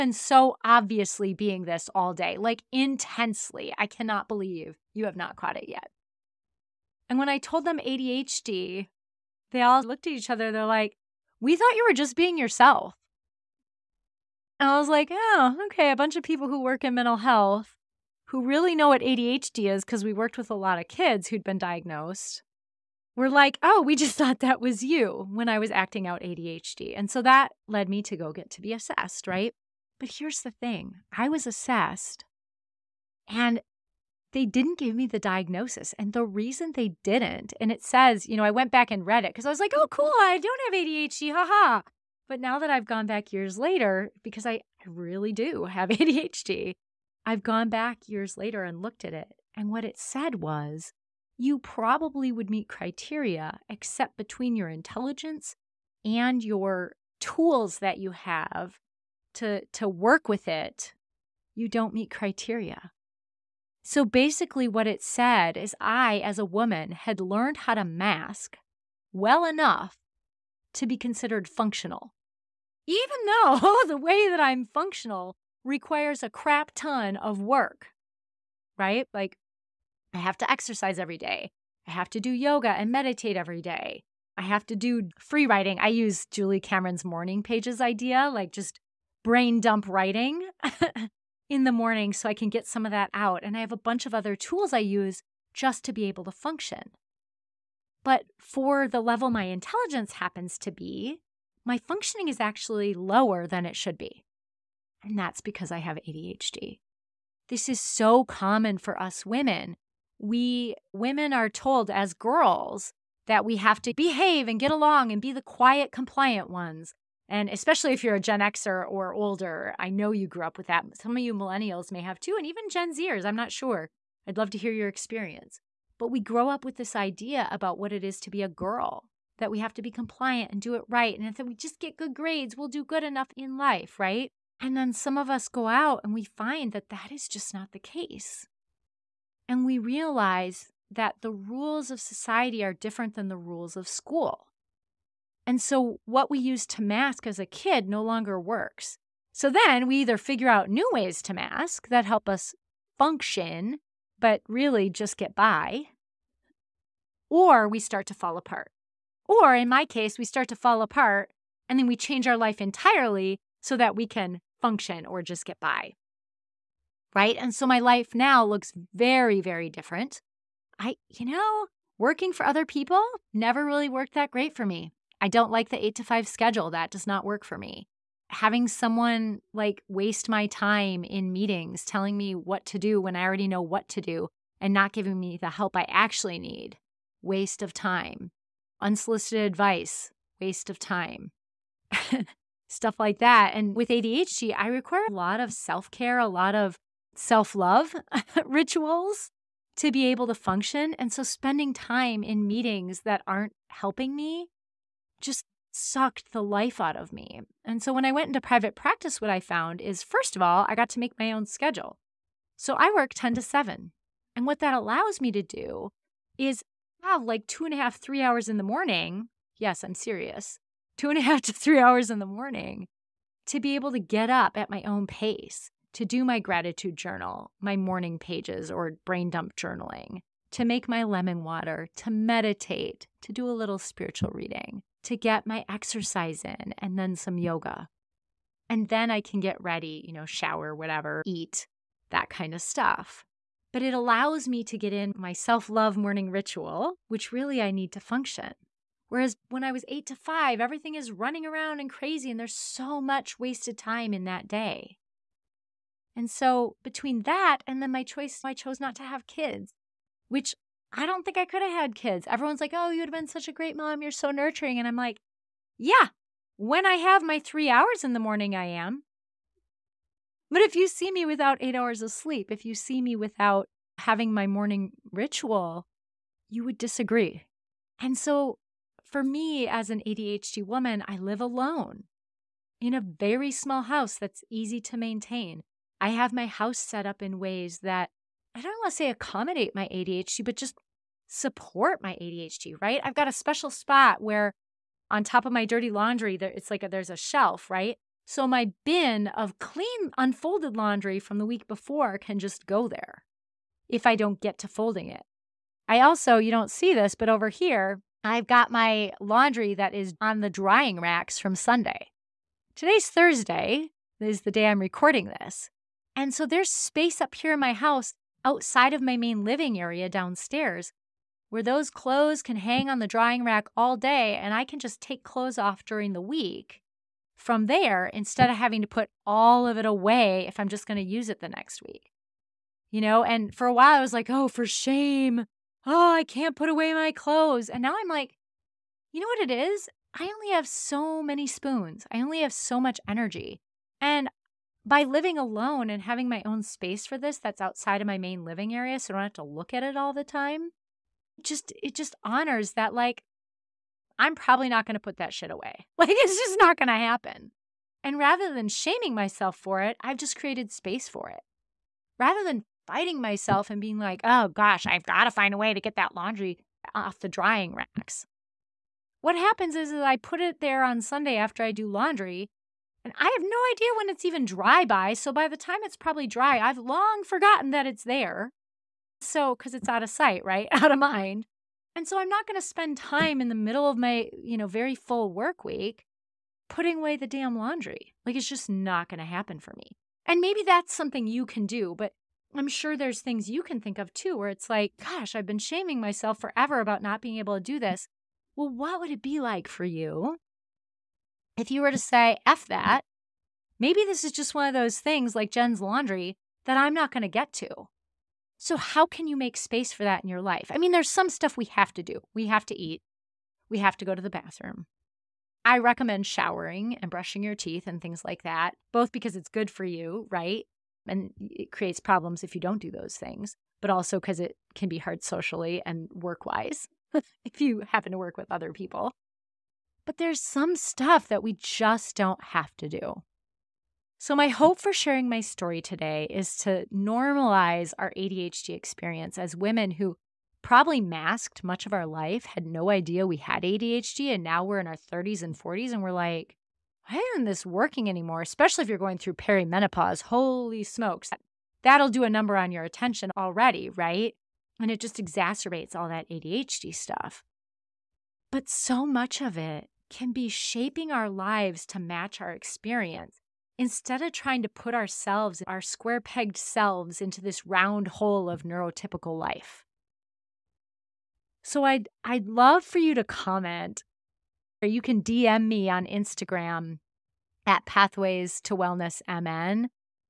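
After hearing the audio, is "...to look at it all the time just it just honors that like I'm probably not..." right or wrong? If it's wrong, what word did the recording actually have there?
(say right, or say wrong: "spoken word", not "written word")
right.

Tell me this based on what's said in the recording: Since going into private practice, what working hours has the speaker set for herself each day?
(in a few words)
10 to 7.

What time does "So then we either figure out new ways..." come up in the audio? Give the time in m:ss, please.
2:29.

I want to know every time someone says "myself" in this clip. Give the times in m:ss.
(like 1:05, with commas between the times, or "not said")
5:59, 6:03, 6:36.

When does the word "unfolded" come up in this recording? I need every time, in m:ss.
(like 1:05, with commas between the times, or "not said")
5:00.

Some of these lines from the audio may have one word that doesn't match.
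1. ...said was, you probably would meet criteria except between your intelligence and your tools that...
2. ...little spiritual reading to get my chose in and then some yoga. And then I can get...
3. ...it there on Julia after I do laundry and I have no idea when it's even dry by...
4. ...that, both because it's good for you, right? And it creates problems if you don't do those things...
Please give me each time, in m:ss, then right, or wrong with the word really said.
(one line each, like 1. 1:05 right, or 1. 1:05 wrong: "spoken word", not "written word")
1. 0:49 right
2. 3:53 wrong: "exercise", not "chose"
3. 6:10 wrong: "Sunday", not "Julia"
4. 6:58 right.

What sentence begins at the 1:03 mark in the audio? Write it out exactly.
So basically, what it said is I, as a woman, had learned how to mask well enough to be considered functional.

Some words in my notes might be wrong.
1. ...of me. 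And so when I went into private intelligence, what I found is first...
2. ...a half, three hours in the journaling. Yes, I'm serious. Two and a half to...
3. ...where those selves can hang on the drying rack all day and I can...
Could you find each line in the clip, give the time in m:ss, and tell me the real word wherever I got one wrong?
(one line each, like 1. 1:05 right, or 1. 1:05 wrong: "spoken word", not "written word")
1. 3:26 wrong: "practice", not "intelligence"
2. 3:37 wrong: "morning", not "journaling"
3. 5:21 wrong: "clothes", not "selves".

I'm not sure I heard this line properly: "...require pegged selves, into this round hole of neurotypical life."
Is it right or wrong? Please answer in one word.
wrong.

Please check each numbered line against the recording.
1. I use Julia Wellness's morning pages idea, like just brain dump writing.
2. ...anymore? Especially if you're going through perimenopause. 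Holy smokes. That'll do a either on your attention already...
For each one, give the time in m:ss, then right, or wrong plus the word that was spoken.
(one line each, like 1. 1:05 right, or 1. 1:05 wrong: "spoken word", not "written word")
1. 1:25 wrong: "Cameron", not "Wellness"
2. 7:28 wrong: "number", not "either".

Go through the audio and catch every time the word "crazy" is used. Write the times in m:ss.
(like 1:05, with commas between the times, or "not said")
4:11.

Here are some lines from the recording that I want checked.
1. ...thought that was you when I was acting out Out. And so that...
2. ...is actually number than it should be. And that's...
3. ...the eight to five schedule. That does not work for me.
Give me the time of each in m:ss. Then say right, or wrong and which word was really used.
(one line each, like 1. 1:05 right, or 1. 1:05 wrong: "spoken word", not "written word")
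1. 0:24 wrong: "ADHD", not "Out"
2. 1:42 wrong: "lower", not "number"
3. 2:55 right.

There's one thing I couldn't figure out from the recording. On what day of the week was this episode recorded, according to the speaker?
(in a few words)
Thursday.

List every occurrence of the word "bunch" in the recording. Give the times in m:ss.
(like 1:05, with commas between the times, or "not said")
0:15, 1:33.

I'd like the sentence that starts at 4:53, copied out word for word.
I've got a special spot where on top of my dirty laundry, there, it's like a, there's a shelf, right?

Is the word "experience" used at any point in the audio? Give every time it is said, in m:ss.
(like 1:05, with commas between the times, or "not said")
2:04, 7:18, 7:42.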